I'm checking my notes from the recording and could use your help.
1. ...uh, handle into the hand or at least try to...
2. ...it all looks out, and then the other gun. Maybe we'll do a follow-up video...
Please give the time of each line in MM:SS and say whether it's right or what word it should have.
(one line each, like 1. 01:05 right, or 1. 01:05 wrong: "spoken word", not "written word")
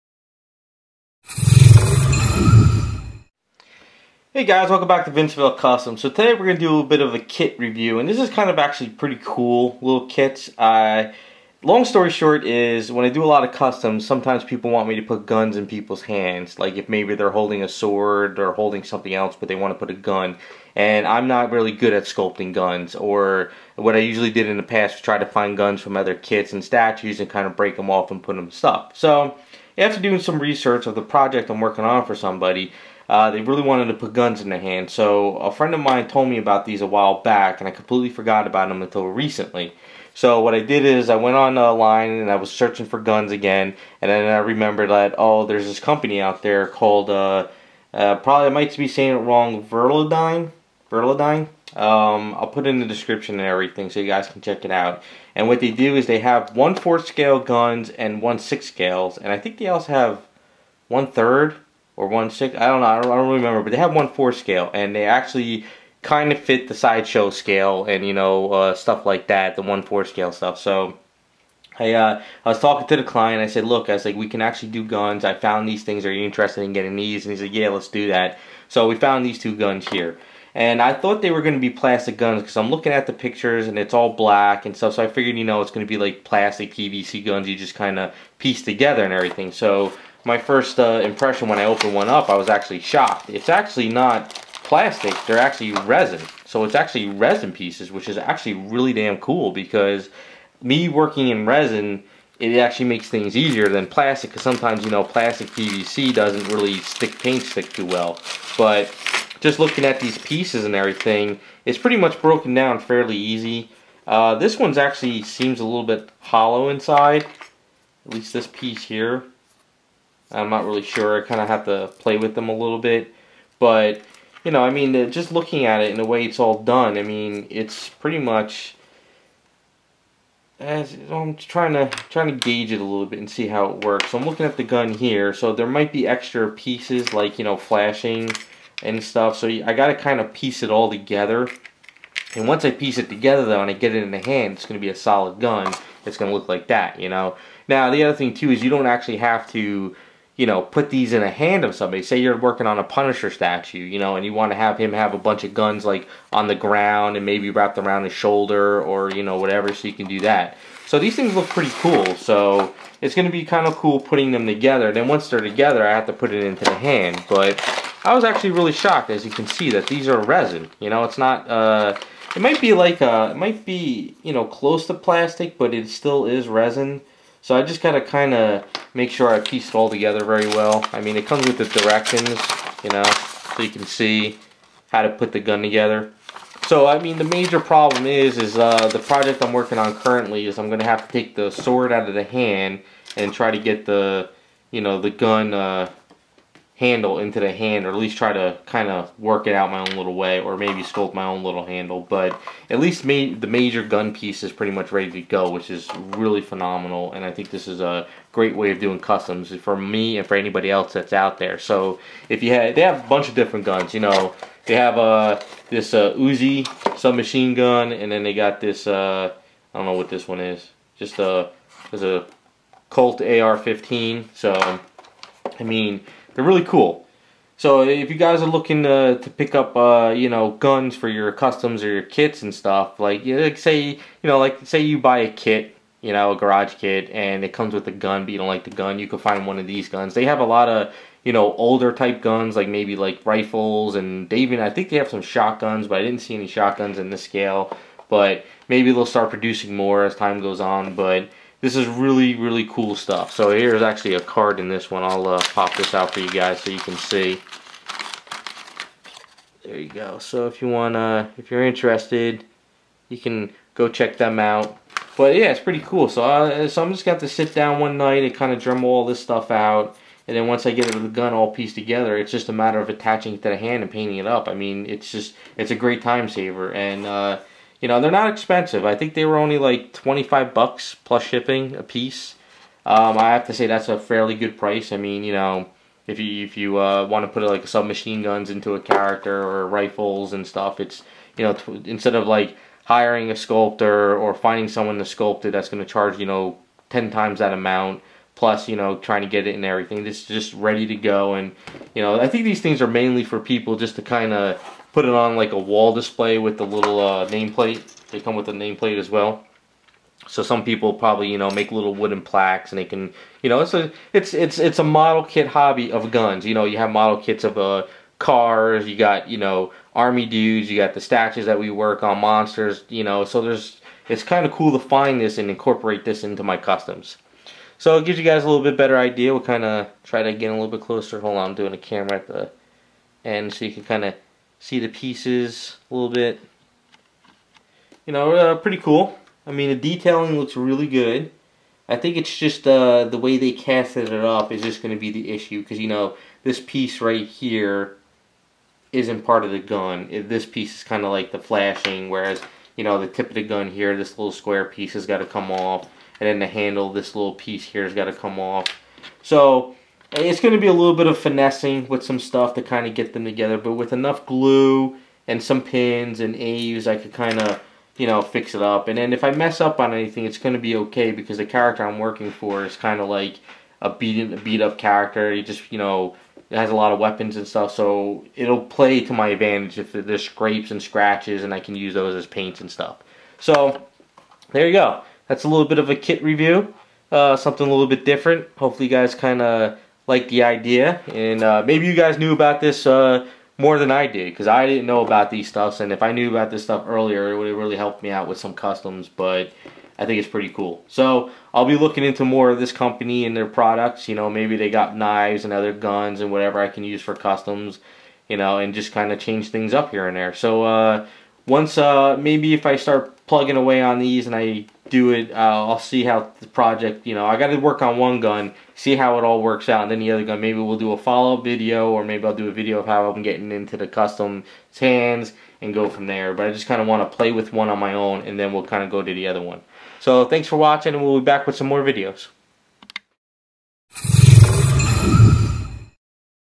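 1. 03:15 right
2. 06:59 wrong: "works", not "looks".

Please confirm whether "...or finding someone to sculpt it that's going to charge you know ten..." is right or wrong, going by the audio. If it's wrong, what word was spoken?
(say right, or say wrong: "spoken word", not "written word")
right.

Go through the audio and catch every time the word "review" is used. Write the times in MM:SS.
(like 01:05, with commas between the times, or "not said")
00:07, 06:26.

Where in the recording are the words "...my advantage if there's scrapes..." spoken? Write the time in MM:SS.
06:19.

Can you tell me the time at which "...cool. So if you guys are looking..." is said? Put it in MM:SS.
03:46.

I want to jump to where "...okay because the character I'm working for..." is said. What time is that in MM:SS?
06:10.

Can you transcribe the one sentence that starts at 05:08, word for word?
They come with a nameplate as well.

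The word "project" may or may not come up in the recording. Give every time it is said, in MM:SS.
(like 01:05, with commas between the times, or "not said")
00:31, 03:08, 06:56.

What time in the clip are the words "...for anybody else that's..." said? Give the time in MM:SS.
03:30.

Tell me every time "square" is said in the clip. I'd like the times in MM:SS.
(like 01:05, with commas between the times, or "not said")
05:54.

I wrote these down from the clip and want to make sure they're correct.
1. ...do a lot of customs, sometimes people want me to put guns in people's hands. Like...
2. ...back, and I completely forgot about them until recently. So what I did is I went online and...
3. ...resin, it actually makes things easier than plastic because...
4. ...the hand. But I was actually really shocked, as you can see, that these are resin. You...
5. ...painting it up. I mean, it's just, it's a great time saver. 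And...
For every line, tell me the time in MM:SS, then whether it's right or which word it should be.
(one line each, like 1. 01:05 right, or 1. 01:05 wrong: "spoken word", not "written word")
1. 00:13 right
2. 00:37 right
3. 01:41 right
4. 02:46 right
5. 04:33 right.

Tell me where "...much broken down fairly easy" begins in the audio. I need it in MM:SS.
01:51.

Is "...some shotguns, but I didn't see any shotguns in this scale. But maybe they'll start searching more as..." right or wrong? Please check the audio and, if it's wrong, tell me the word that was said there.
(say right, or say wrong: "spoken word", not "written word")
wrong: "producing", not "searching".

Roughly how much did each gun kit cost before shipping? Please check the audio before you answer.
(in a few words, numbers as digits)
$25.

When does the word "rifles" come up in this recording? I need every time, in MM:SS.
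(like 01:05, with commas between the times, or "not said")
04:03, 04:49.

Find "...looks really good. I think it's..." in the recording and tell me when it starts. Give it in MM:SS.
05:40.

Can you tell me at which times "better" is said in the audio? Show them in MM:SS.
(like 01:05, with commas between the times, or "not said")
05:28.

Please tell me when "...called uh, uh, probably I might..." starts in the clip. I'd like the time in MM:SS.
00:46.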